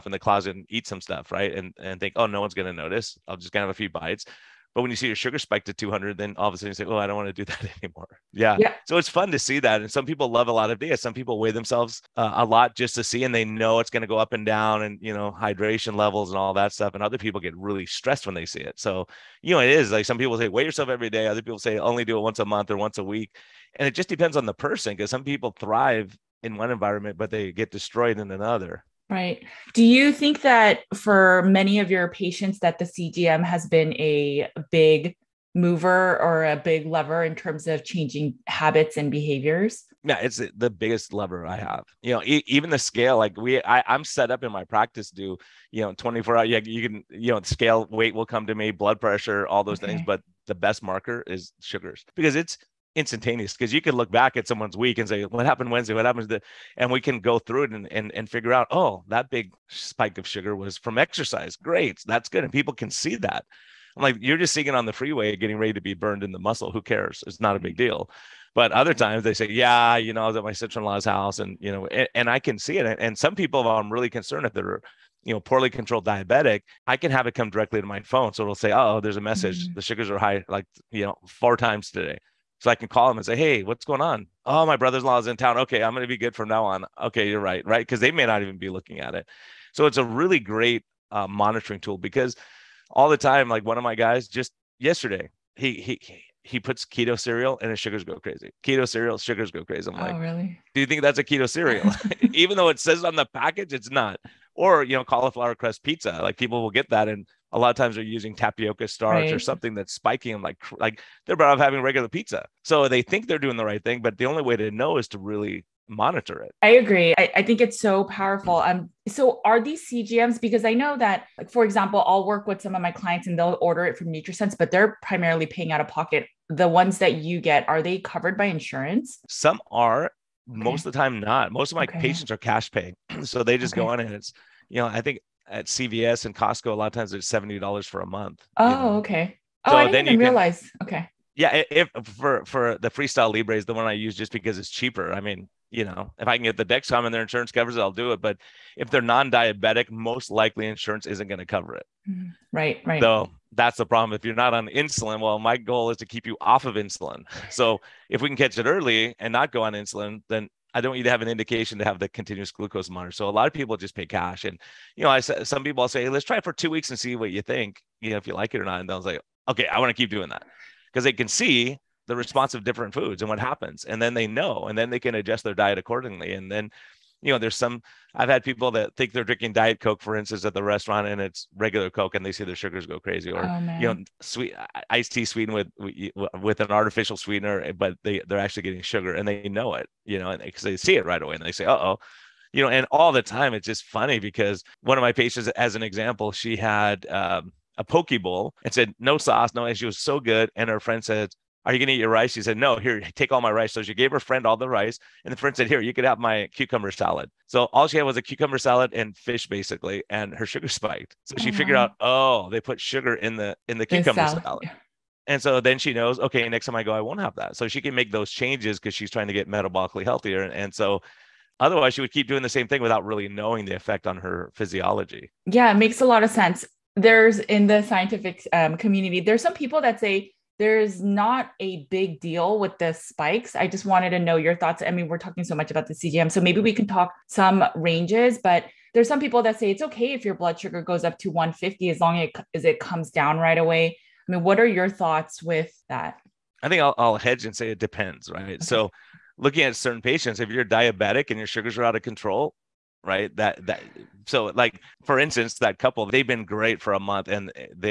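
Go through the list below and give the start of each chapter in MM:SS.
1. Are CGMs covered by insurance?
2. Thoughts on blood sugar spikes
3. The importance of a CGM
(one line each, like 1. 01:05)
1. 01:59
2. 03:46
3. 00:29.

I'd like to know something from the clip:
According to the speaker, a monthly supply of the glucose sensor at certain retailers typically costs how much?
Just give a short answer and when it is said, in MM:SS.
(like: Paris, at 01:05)
$70, at 02:17.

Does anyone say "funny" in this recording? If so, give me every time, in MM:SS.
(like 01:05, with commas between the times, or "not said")
03:13.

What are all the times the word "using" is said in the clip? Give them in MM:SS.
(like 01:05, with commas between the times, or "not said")
01:48.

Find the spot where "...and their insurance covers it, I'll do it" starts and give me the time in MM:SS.
02:27.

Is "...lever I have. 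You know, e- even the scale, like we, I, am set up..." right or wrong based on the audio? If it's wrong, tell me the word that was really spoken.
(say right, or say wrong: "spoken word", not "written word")
right.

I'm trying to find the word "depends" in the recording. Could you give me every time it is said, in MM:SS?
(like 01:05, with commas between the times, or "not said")
00:24, 04:07.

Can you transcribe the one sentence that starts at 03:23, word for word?
So she gave her friend all the rice.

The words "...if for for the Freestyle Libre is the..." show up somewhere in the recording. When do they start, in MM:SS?
02:21.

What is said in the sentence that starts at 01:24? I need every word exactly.
Oh, my brother-in-law is in town.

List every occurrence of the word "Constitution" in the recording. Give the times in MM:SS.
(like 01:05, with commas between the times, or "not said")
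not said.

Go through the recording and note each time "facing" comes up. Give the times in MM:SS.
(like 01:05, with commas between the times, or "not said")
not said.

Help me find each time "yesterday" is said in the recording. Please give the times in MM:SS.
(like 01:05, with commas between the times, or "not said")
01:34.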